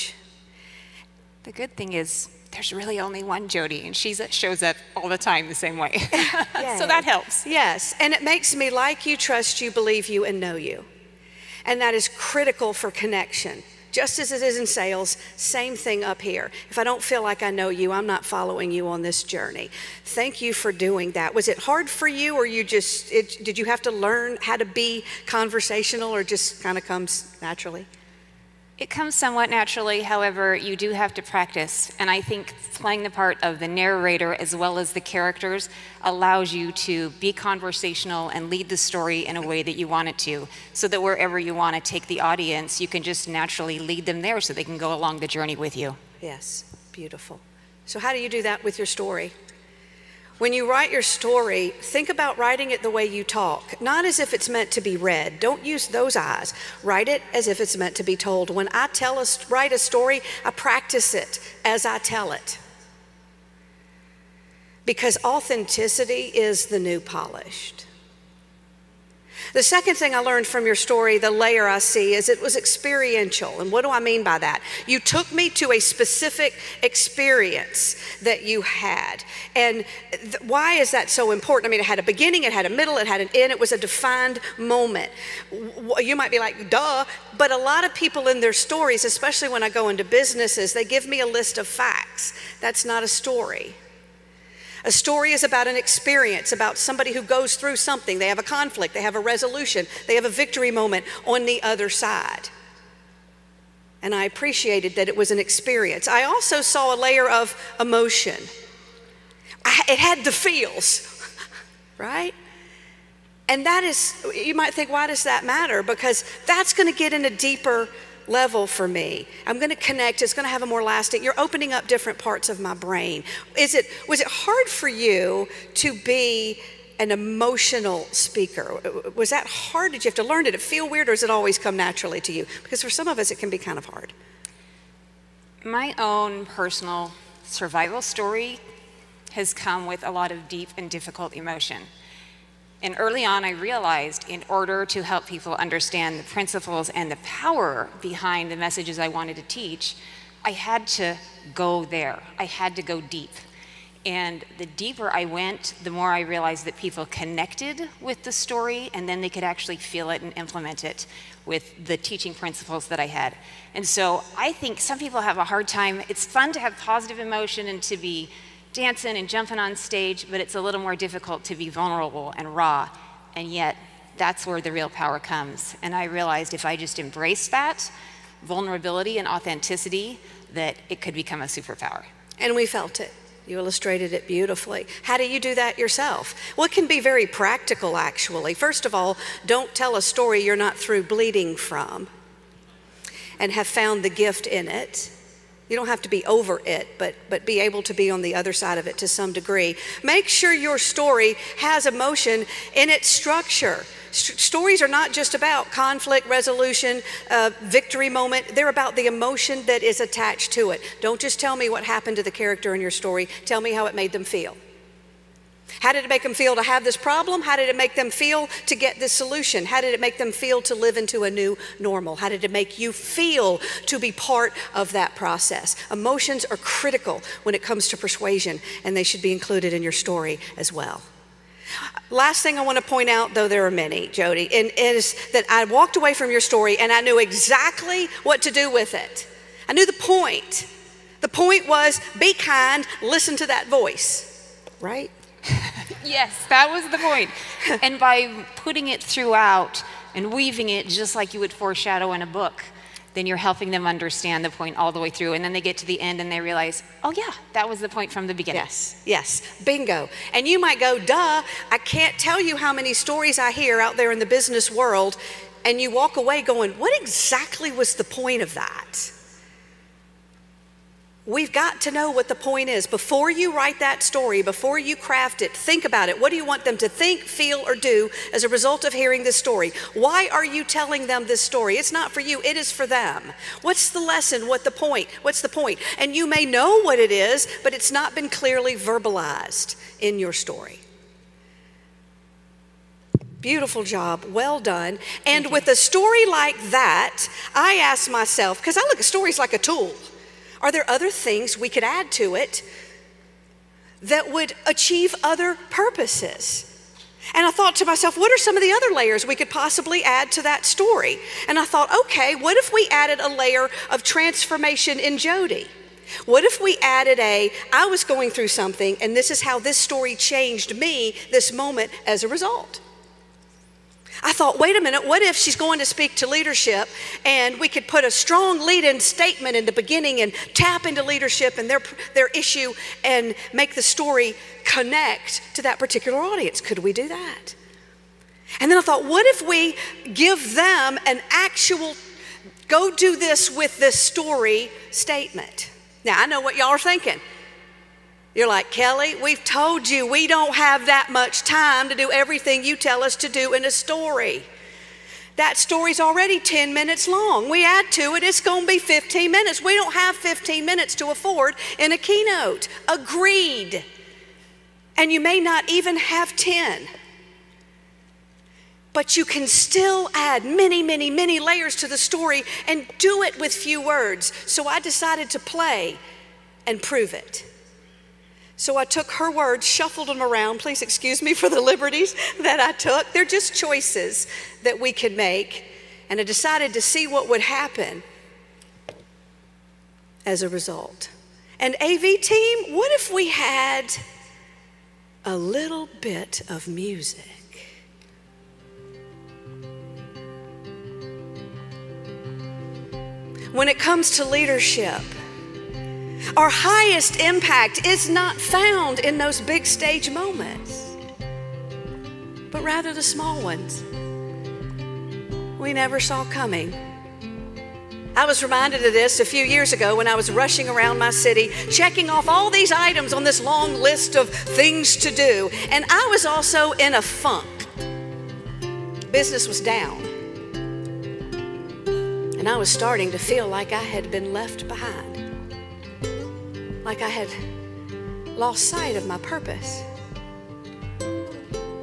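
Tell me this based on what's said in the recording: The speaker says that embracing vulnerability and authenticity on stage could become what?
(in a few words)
A superpower.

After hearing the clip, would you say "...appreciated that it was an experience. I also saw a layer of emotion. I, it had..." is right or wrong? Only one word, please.
right.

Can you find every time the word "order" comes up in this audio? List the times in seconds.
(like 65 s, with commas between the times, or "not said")
144 s.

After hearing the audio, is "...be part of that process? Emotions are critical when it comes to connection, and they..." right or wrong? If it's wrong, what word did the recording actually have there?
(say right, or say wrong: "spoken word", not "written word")
wrong: "persuasion", not "connection".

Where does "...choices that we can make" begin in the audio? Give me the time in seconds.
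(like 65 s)
383 s.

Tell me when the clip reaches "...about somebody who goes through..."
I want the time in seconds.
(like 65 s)
96 s.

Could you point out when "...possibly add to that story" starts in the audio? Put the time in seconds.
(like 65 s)
309 s.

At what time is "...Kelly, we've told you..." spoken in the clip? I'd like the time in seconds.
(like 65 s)
348 s.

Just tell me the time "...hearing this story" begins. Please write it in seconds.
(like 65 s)
278 s.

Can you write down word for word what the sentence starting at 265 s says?
And you walk away going, what exactly was the point of that?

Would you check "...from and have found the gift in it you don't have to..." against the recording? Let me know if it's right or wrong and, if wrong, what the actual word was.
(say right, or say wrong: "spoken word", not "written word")
right.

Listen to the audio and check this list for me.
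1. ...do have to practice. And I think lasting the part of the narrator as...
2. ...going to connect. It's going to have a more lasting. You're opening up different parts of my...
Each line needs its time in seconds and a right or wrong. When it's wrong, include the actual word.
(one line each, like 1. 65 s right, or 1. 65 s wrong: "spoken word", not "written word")
1. 30 s wrong: "playing", not "lasting"
2. 119 s right.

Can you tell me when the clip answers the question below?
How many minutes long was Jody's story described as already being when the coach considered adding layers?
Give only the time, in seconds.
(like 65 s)
356 s.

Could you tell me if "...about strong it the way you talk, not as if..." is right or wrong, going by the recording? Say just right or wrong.
wrong.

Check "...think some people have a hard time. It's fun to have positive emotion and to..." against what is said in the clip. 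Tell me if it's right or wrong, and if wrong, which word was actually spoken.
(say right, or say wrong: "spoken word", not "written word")
right.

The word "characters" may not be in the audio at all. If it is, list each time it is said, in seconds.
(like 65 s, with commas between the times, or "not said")
35 s, 212 s.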